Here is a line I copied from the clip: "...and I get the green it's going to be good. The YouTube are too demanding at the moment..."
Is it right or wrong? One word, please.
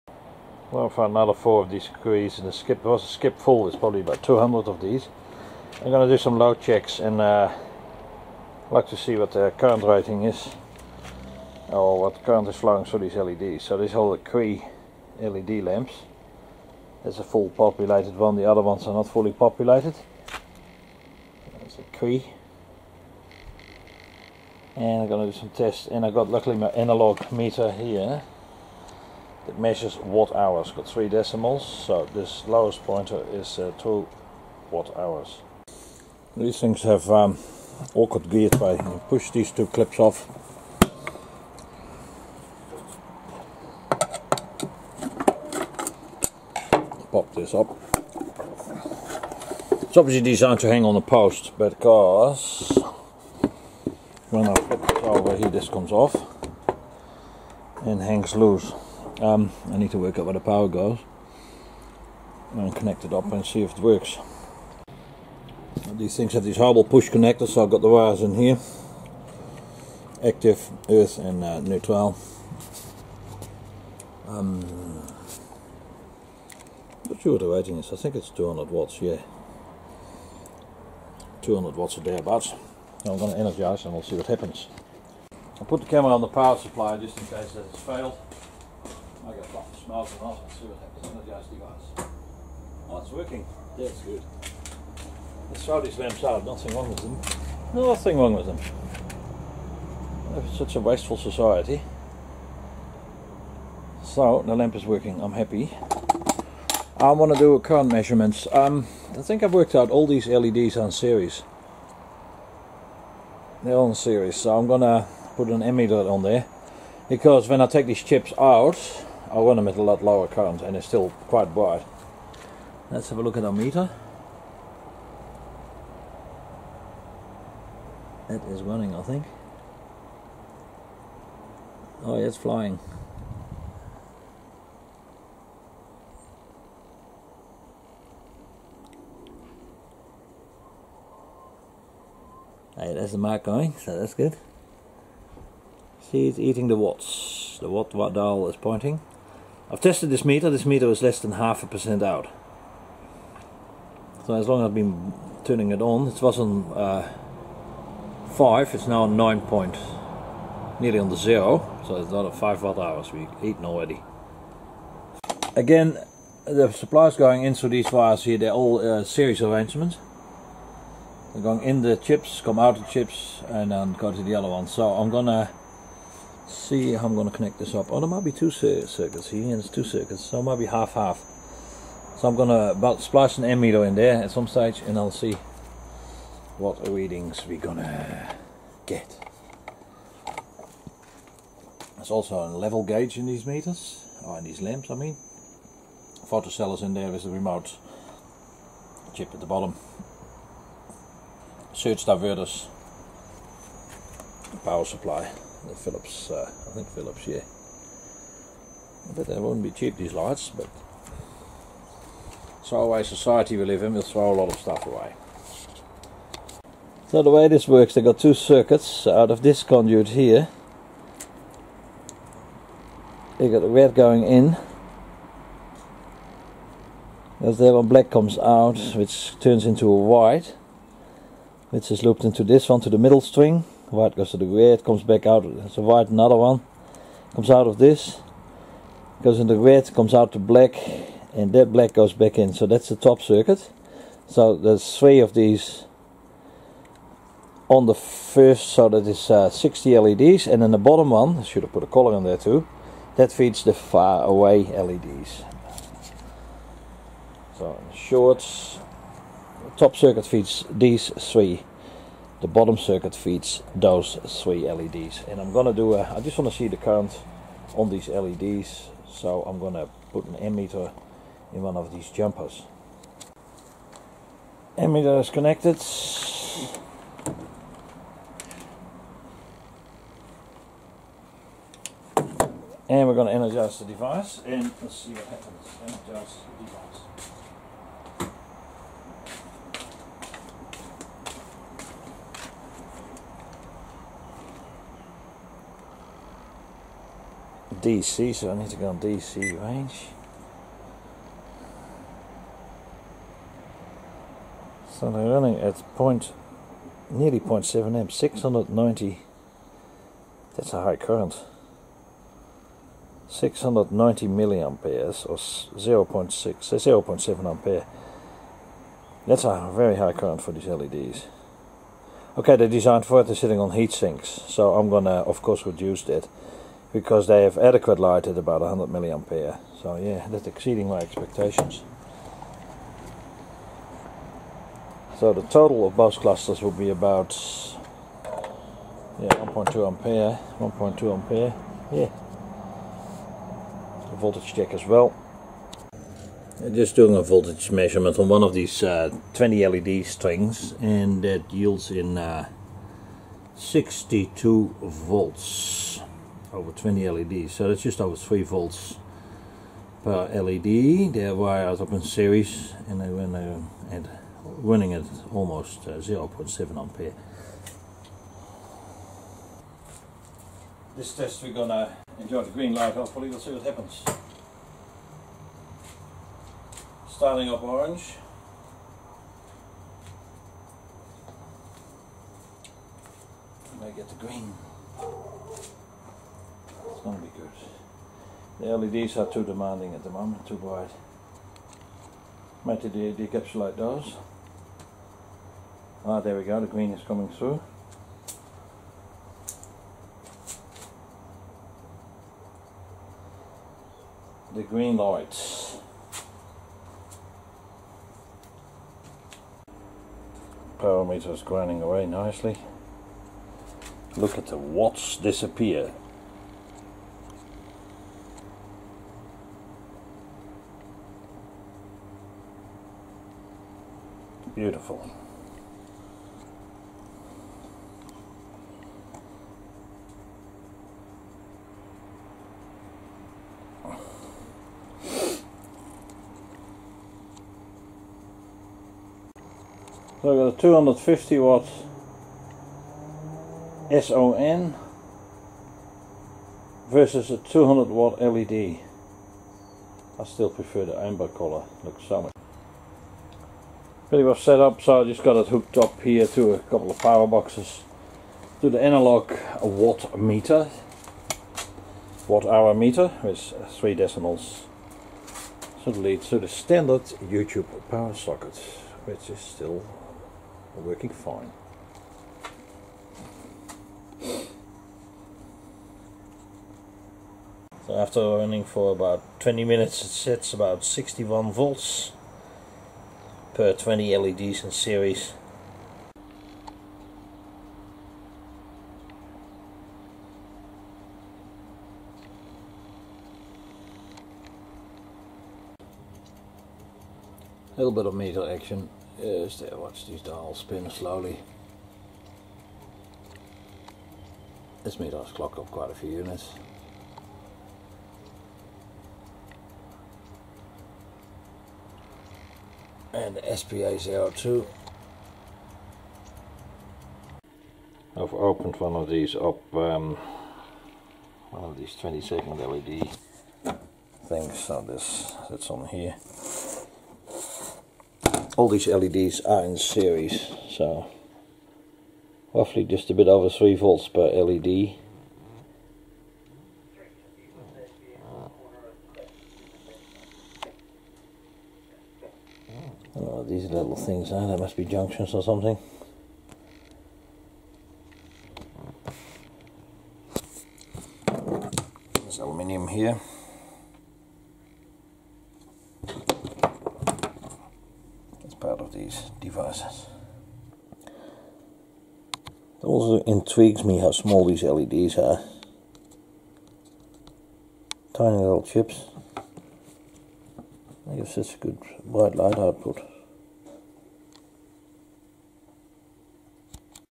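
wrong.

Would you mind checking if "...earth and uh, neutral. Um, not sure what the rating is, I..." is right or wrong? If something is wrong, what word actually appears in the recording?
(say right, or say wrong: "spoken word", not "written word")
right.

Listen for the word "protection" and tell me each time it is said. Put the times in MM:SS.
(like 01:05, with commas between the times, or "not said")
not said.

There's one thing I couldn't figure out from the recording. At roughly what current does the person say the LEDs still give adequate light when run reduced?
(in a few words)
100 milliamperes.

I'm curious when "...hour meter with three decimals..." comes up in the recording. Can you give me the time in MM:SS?
07:42.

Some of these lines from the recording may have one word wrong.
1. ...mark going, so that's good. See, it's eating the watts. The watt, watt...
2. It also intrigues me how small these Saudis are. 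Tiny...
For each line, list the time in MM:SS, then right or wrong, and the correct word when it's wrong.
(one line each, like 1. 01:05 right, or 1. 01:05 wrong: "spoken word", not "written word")
1. 02:23 right
2. 09:21 wrong: "LEDs", not "Saudis".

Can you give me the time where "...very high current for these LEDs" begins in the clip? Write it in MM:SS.
05:19.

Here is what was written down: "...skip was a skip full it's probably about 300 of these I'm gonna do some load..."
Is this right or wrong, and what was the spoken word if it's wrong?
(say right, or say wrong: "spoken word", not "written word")
wrong: "200", not "300".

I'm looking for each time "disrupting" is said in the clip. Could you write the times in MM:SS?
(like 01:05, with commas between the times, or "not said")
not said.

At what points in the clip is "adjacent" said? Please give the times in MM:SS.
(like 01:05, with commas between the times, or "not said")
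not said.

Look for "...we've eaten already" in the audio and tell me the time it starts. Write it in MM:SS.
02:43.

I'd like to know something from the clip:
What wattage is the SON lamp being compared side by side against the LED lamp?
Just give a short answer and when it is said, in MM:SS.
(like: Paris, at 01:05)
250 watts, at 07:20.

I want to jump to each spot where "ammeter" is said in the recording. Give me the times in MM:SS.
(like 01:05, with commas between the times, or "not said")
01:55, 03:03, 04:30, 04:34.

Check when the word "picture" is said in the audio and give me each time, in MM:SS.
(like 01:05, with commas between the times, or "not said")
not said.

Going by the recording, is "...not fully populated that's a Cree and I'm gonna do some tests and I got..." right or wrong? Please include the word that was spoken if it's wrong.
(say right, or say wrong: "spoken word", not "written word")
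right.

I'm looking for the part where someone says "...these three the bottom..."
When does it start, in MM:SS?
04:20.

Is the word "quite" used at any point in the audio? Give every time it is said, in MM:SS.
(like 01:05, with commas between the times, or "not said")
02:01, 08:25.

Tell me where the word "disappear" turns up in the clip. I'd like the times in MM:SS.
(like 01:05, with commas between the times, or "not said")
06:55.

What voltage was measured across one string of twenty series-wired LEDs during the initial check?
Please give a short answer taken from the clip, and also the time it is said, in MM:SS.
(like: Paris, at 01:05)
62 volts, at 05:53.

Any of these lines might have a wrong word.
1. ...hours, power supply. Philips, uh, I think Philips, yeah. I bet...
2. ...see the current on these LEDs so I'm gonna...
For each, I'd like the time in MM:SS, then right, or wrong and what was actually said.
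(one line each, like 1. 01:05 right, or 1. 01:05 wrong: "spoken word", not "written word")
1. 03:22 wrong: "diverters", not "hours"
2. 04:26 right.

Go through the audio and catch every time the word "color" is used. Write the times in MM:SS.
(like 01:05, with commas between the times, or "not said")
04:11, 07:31.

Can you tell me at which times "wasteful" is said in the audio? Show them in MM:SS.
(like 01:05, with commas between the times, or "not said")
01:40.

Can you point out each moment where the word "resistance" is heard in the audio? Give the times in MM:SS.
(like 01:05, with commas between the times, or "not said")
not said.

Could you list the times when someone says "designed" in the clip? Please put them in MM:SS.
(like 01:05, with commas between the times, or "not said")
00:50, 05:22.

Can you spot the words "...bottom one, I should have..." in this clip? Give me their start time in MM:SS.
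04:10.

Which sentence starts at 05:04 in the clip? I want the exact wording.
So they're running at point, nearly 0.7 amps, 690.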